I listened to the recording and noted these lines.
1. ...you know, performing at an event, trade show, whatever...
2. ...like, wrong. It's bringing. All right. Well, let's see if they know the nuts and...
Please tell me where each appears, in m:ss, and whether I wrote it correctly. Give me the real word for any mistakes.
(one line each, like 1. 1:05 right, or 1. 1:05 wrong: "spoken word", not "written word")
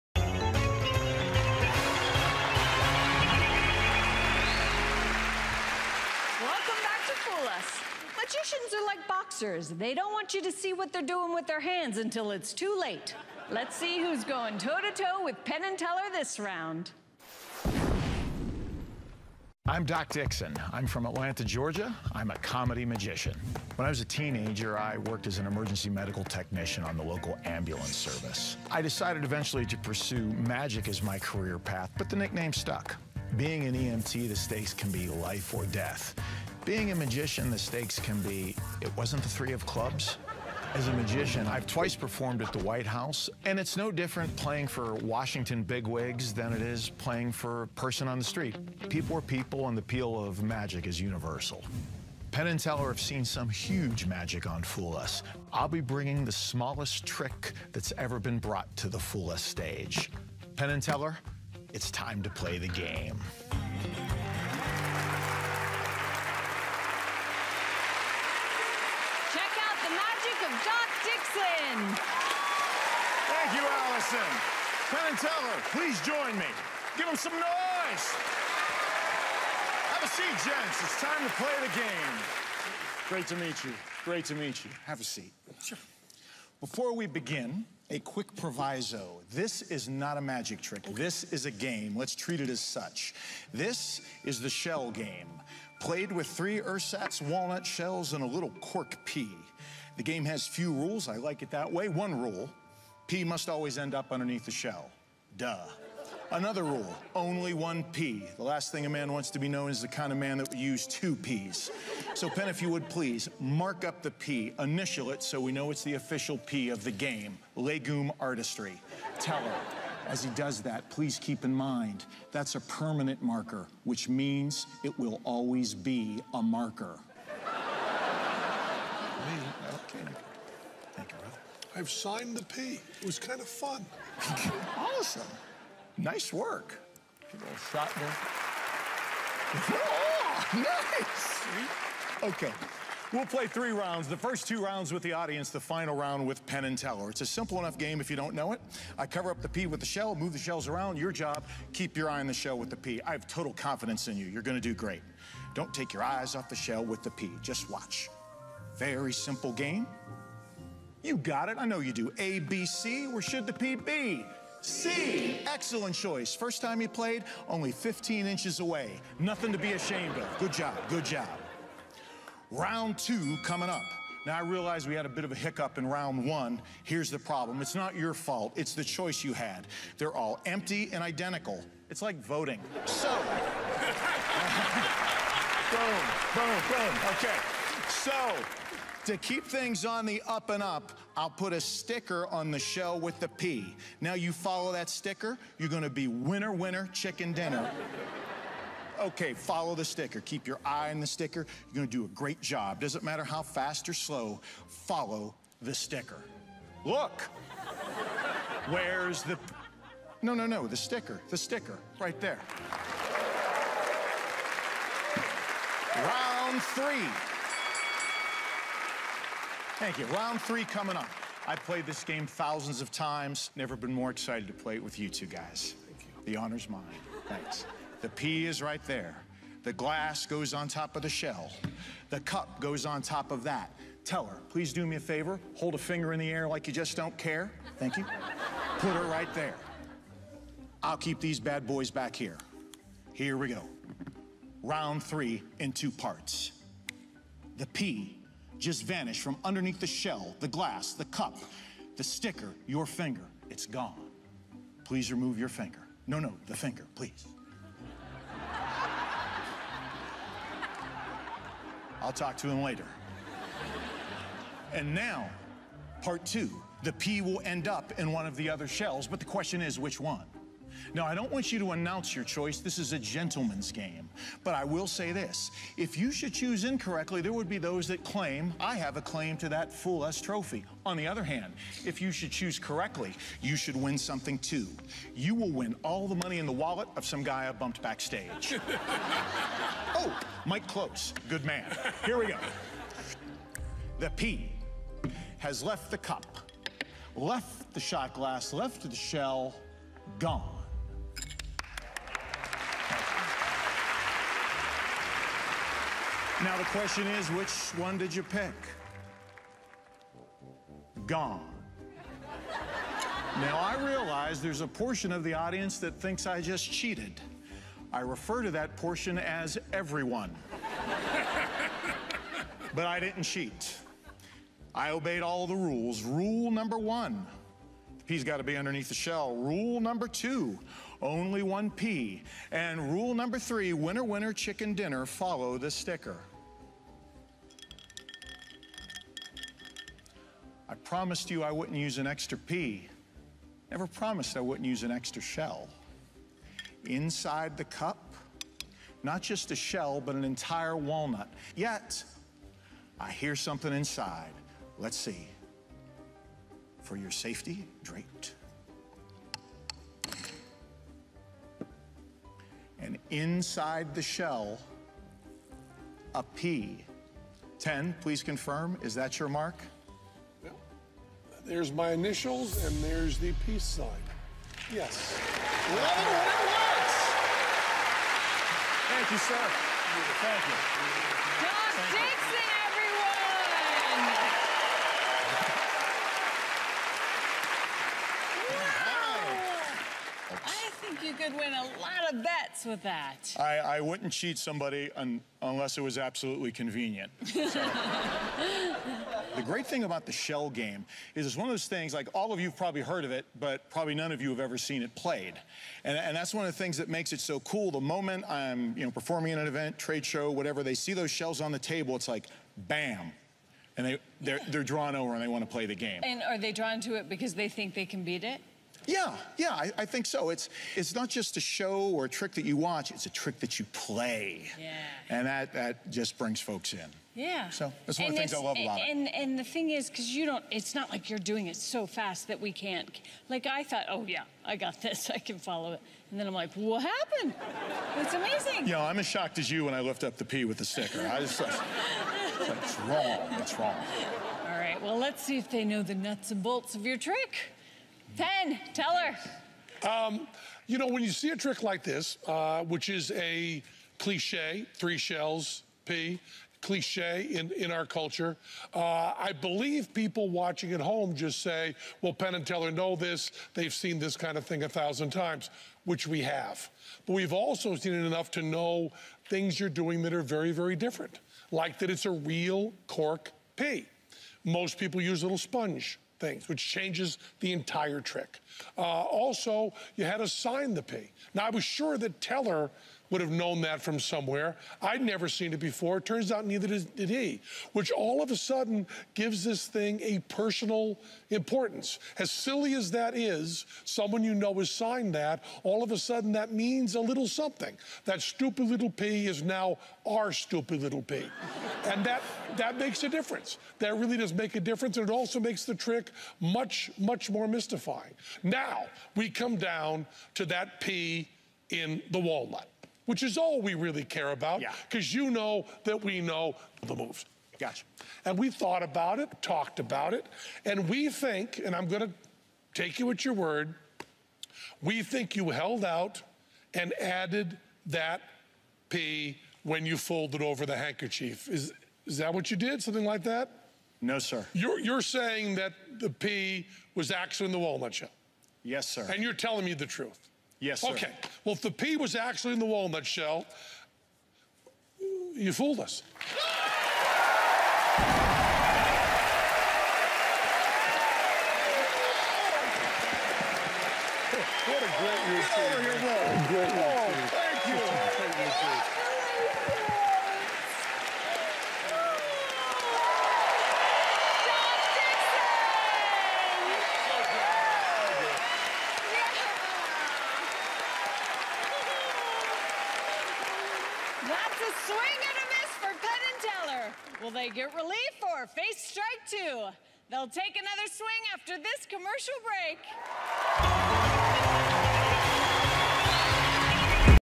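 1. 6:48 right
2. 7:22 wrong: "wrong", not "bringing".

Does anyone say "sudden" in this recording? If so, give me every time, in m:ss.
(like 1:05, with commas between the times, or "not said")
8:08, 8:15.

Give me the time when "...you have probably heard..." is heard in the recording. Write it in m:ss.
6:42.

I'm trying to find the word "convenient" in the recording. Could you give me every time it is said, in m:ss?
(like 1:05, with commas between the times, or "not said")
6:36.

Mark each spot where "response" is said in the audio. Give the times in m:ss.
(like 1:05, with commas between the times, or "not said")
not said.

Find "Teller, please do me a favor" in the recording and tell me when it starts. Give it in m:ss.
3:54.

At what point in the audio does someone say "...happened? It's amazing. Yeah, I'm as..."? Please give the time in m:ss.
7:16.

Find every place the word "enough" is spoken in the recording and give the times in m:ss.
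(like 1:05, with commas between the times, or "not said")
2:27, 7:48.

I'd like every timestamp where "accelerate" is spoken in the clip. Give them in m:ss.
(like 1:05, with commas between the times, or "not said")
not said.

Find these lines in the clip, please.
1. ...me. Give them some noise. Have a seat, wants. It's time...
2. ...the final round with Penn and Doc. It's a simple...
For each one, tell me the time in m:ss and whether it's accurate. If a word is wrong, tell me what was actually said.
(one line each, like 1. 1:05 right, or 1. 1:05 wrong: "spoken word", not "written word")
1. 1:16 wrong: "gents", not "wants"
2. 2:25 wrong: "Teller", not "Doc".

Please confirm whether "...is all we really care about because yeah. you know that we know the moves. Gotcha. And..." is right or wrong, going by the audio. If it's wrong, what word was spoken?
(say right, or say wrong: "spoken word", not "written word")
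right.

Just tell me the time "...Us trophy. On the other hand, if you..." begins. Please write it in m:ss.
4:40.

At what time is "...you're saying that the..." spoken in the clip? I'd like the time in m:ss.
8:54.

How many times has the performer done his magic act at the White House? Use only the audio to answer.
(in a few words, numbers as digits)
2.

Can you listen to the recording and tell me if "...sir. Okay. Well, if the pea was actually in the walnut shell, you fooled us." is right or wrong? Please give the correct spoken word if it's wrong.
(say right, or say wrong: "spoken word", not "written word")
right.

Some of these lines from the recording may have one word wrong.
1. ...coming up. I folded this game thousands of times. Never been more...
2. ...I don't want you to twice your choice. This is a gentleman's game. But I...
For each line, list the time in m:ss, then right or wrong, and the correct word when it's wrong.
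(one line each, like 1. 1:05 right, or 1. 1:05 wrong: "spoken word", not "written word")
1. 3:40 wrong: "played", not "folded"
2. 4:31 wrong: "announce", not "twice".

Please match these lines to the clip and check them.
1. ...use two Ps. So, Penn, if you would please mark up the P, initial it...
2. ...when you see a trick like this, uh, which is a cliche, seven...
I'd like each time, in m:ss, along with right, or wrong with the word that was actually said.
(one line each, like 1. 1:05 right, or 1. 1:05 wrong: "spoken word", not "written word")
1. 1:50 right
2. 7:30 wrong: "three", not "seven".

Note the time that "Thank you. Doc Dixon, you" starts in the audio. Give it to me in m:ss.
6:20.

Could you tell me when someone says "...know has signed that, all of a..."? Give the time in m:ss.
8:14.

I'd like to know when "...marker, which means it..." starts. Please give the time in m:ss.
2:03.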